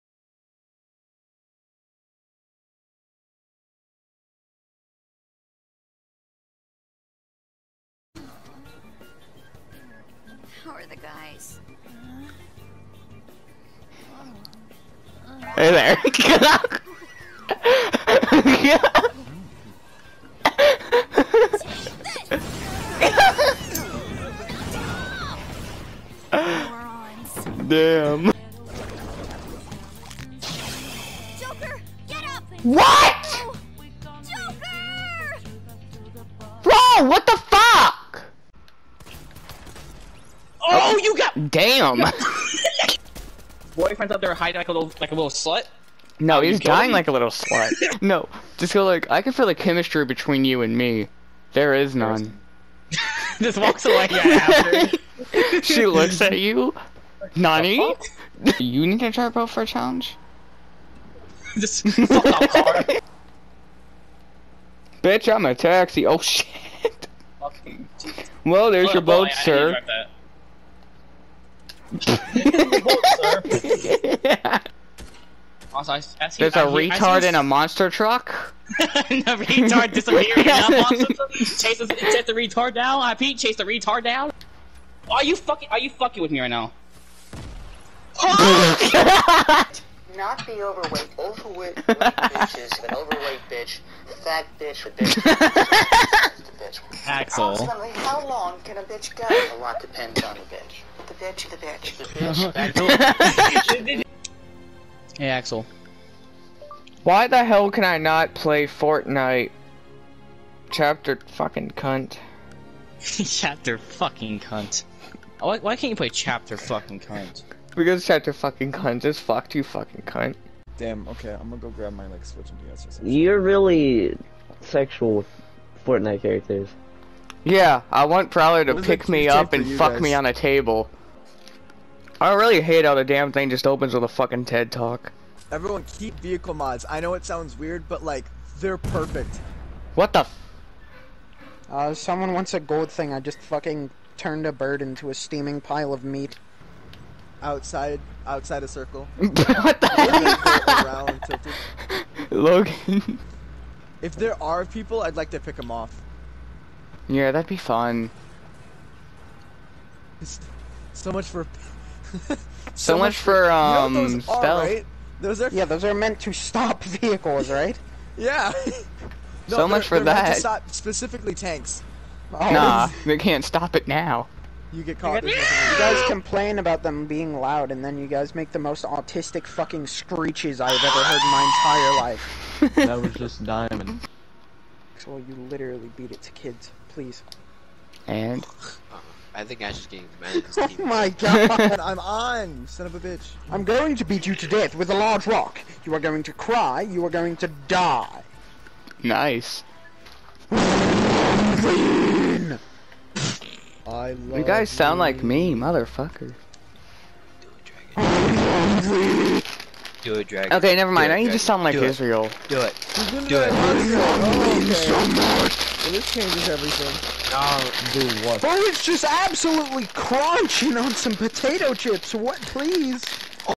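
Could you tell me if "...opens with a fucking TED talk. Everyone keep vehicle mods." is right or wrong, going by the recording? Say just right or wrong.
right.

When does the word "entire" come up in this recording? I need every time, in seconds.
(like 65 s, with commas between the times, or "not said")
181 s.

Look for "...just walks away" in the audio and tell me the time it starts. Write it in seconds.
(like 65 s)
53 s.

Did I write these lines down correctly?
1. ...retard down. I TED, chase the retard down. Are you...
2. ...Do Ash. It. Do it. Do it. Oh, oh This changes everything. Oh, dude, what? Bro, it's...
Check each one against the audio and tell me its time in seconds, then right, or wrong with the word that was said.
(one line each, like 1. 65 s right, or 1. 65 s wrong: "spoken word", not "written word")
1. 82 s wrong: "Pete", not "TED"
2. 211 s wrong: "Israel", not "Ash".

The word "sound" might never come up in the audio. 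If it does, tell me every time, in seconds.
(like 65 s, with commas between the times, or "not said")
137 s, 204 s, 211 s.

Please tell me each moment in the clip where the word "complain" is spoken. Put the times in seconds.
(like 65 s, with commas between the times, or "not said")
176 s.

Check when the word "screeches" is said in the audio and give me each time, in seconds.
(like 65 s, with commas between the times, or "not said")
179 s.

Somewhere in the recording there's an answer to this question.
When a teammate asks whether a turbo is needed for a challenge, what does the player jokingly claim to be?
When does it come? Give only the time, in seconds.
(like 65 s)
65 s.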